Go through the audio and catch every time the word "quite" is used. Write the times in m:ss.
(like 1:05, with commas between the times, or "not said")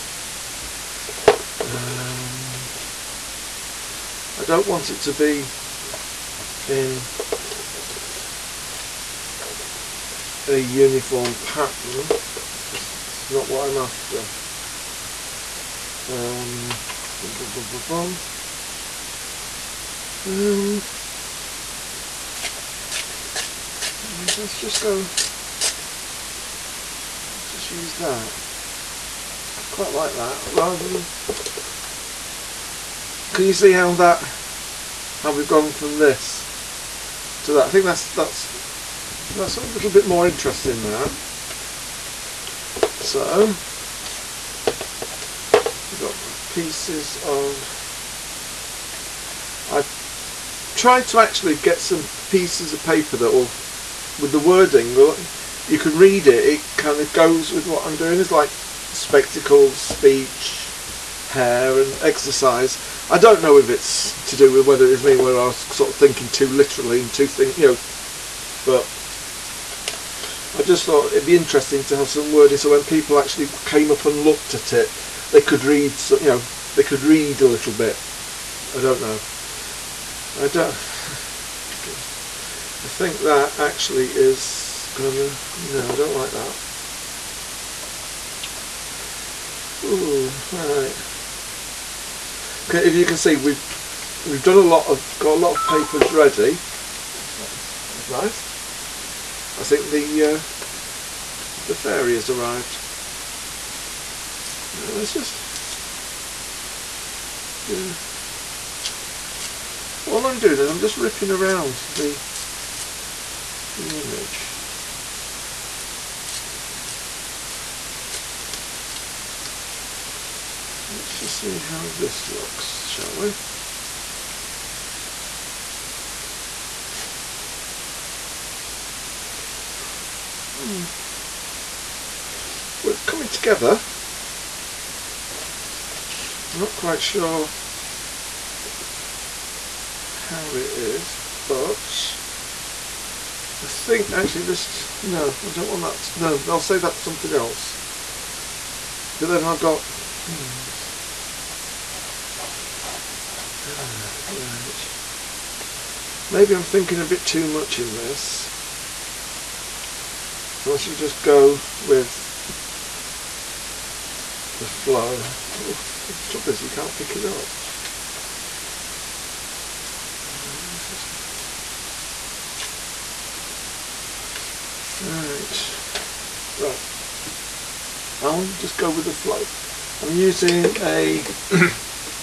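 0:29, 2:16.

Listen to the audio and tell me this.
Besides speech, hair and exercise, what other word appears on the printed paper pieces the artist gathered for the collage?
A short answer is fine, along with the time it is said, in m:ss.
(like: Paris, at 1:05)
spectacles, at 0:58.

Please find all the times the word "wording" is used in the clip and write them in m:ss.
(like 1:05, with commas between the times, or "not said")
0:54, 1:12.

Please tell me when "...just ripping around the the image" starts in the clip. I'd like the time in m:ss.
1:50.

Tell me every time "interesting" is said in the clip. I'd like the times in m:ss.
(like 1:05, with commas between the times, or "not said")
0:40, 1:11.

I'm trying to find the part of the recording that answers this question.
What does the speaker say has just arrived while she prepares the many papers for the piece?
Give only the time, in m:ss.
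1:41.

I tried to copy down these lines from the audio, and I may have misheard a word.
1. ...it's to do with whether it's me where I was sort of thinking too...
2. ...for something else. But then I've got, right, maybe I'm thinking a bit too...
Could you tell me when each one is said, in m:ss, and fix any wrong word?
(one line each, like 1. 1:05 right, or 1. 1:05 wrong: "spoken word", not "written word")
1. 1:03 right
2. 2:26 right.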